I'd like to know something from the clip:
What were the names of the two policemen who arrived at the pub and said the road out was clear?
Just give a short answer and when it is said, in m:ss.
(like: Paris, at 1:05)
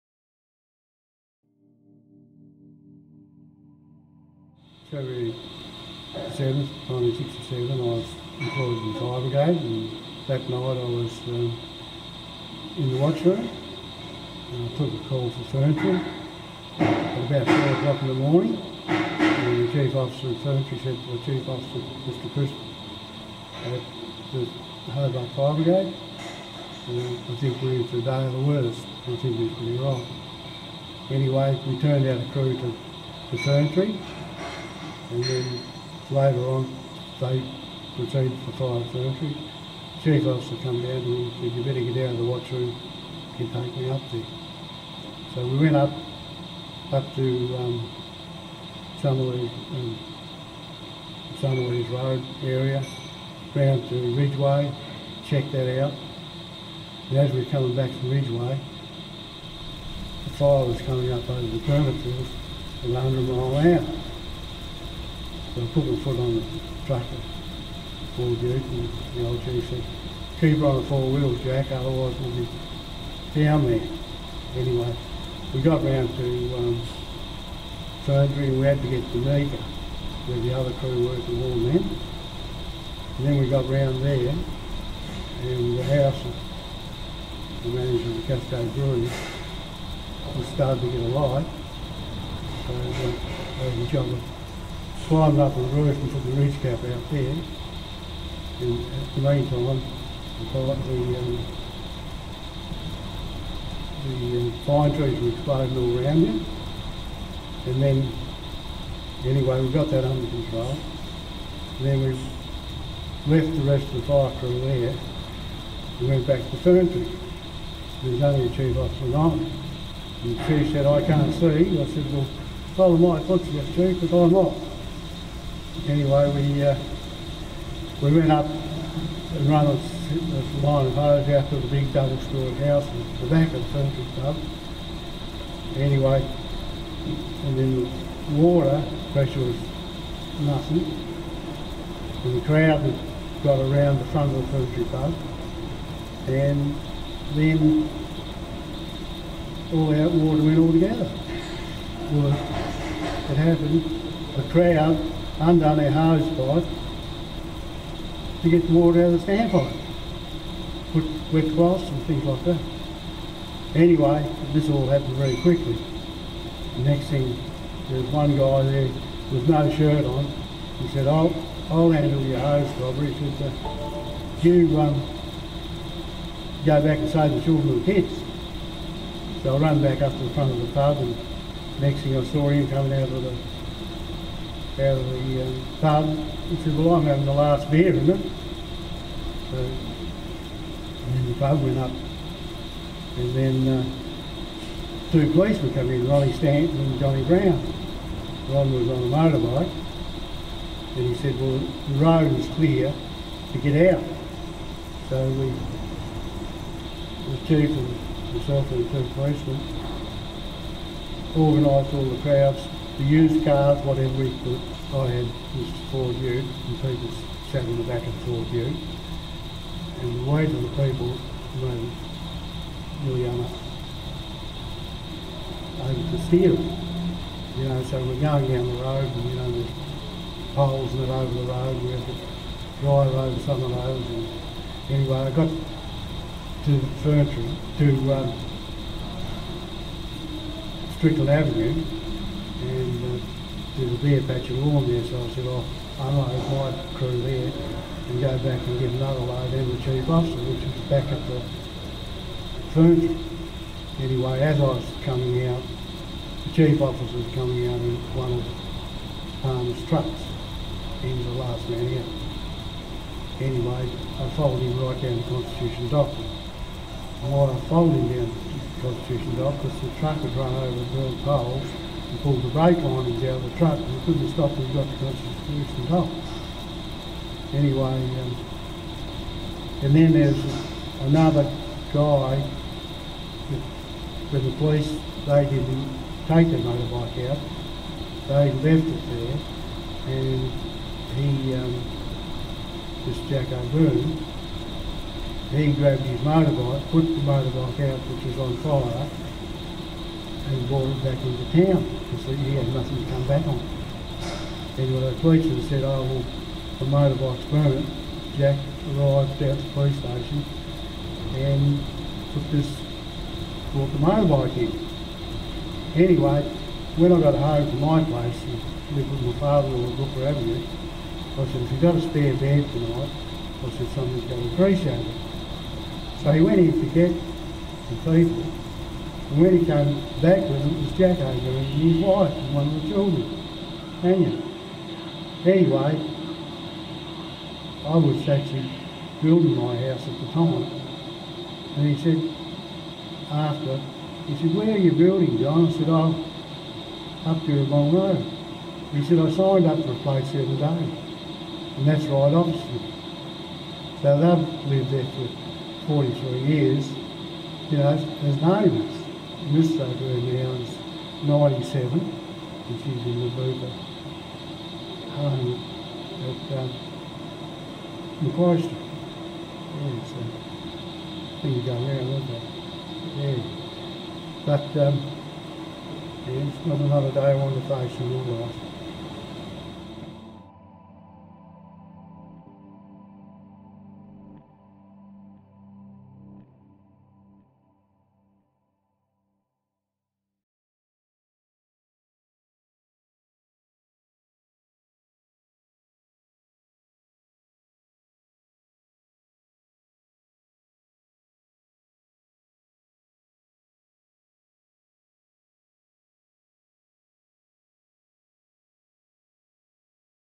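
Ronnie Stanton and Johnny Brown, at 3:16.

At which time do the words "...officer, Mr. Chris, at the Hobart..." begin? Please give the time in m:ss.
0:21.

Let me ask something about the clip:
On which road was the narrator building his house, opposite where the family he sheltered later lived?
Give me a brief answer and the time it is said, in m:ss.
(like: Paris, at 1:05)
Long Road, at 5:47.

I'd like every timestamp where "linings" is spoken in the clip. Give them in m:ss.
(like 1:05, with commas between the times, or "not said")
4:32.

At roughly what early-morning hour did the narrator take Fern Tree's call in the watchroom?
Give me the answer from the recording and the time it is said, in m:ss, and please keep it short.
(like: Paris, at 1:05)
4 o'clock, at 0:17.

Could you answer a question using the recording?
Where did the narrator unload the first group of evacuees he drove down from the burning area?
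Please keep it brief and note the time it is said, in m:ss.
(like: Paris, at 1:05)
Strickland Avenue, at 4:00.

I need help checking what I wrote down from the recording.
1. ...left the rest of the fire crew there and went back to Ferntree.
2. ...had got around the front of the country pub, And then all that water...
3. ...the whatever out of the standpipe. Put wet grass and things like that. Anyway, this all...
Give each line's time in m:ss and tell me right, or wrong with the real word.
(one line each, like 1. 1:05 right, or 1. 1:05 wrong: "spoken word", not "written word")
1. 1:53 right
2. 2:22 right
3. 2:38 wrong: "water", not "whatever".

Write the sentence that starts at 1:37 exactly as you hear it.
And at uh, the meantime, the, um, the um, pine trees were exploding all around you.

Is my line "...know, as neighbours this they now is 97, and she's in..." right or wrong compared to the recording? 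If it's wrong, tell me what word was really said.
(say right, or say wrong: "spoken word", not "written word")
right.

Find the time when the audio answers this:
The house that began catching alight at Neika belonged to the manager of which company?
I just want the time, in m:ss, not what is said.
1:28.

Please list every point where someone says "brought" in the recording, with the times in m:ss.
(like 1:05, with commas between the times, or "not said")
5:00, 5:13.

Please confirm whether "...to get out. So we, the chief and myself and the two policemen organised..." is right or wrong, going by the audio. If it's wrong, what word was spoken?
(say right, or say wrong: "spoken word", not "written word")
right.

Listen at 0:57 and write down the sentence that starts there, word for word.
And as we were coming back from Ridgeway, the fire was coming up over the turnip around them all mile an hour.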